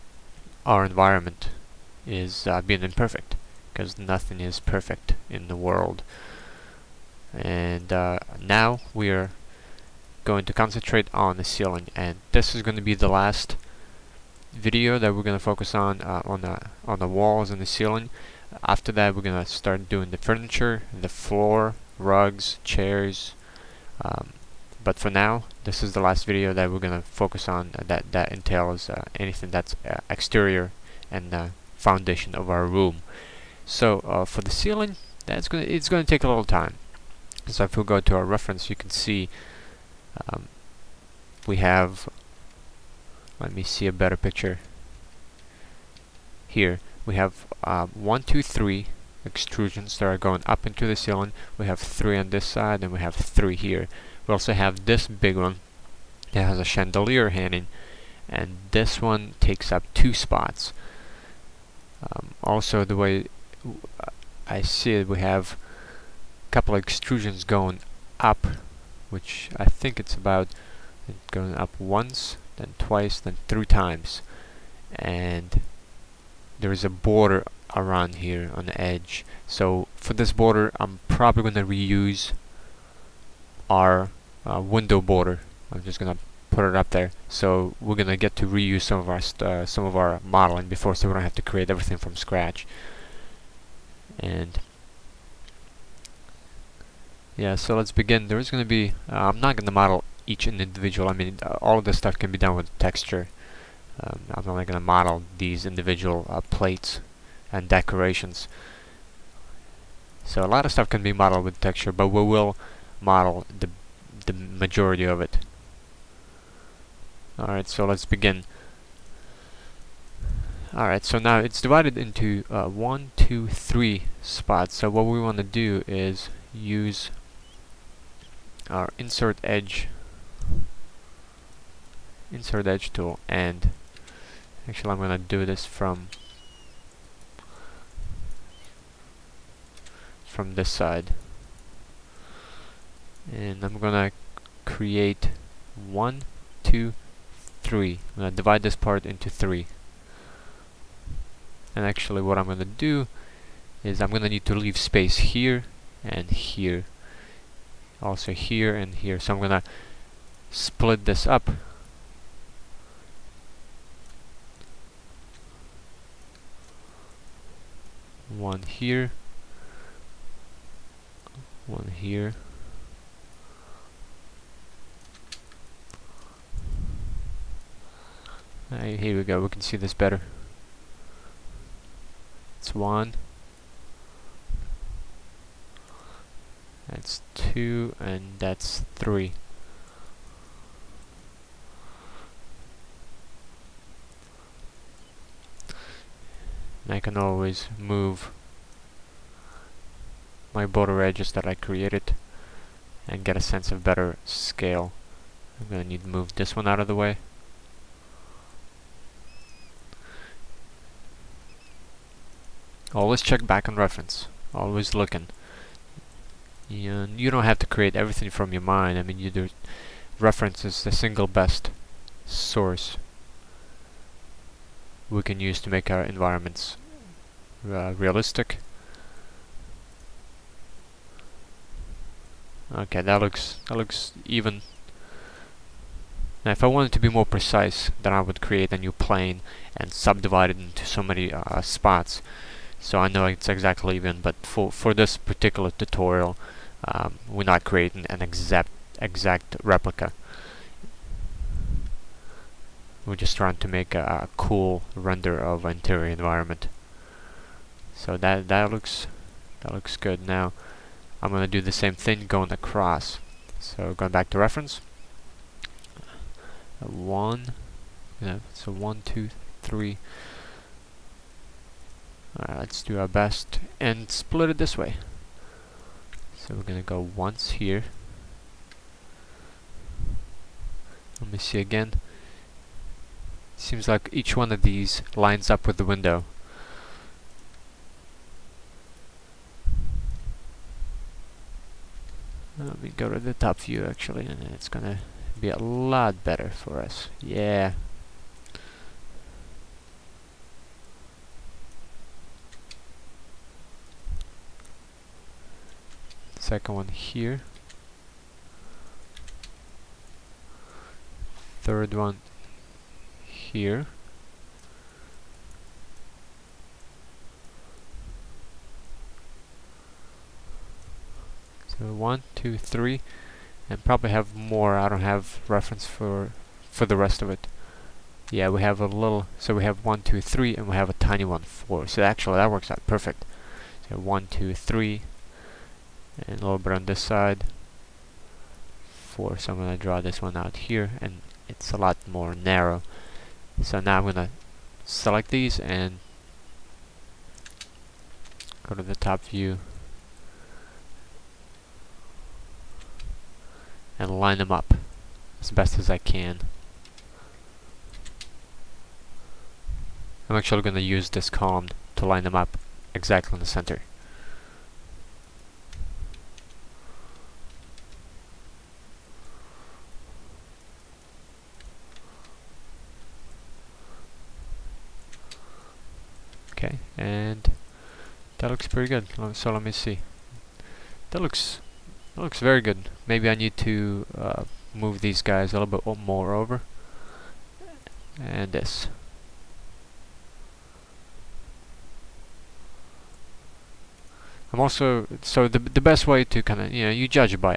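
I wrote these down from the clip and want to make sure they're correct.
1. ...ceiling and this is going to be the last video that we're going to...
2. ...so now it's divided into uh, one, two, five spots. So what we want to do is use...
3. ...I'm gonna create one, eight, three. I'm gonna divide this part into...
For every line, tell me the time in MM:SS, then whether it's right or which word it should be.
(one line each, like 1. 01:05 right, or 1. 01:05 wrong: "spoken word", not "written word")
1. 00:11 right
2. 02:01 wrong: "three", not "five"
3. 02:23 wrong: "two", not "eight".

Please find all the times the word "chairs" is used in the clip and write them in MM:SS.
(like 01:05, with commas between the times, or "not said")
00:22.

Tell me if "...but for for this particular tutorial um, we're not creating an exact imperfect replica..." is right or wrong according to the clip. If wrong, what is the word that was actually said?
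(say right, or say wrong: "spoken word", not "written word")
wrong: "exact", not "imperfect".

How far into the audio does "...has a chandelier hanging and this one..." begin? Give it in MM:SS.
00:56.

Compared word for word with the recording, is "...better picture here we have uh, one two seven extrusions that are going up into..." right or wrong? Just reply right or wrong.
wrong.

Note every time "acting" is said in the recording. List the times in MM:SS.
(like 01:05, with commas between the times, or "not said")
not said.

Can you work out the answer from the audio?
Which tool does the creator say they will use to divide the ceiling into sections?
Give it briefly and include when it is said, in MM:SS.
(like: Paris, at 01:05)
Insert edge tool, at 02:12.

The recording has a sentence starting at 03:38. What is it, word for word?
I mean, you do reference is the single best source we can use to make our environments uh, realistic.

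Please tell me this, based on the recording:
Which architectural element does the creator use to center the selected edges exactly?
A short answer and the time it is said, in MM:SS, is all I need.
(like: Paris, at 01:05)
Column, at 06:01.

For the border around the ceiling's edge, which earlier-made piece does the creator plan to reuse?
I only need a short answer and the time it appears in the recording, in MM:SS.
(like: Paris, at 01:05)
Window border, at 01:24.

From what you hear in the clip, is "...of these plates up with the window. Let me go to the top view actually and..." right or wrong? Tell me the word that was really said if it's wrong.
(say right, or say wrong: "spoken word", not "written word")
wrong: "lines", not "plates".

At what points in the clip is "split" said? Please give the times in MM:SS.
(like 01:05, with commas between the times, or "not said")
02:40, 04:34.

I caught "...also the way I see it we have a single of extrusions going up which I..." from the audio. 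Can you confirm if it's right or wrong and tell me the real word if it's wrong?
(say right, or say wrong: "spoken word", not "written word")
wrong: "couple", not "single".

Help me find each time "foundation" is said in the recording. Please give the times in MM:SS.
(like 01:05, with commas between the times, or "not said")
00:31.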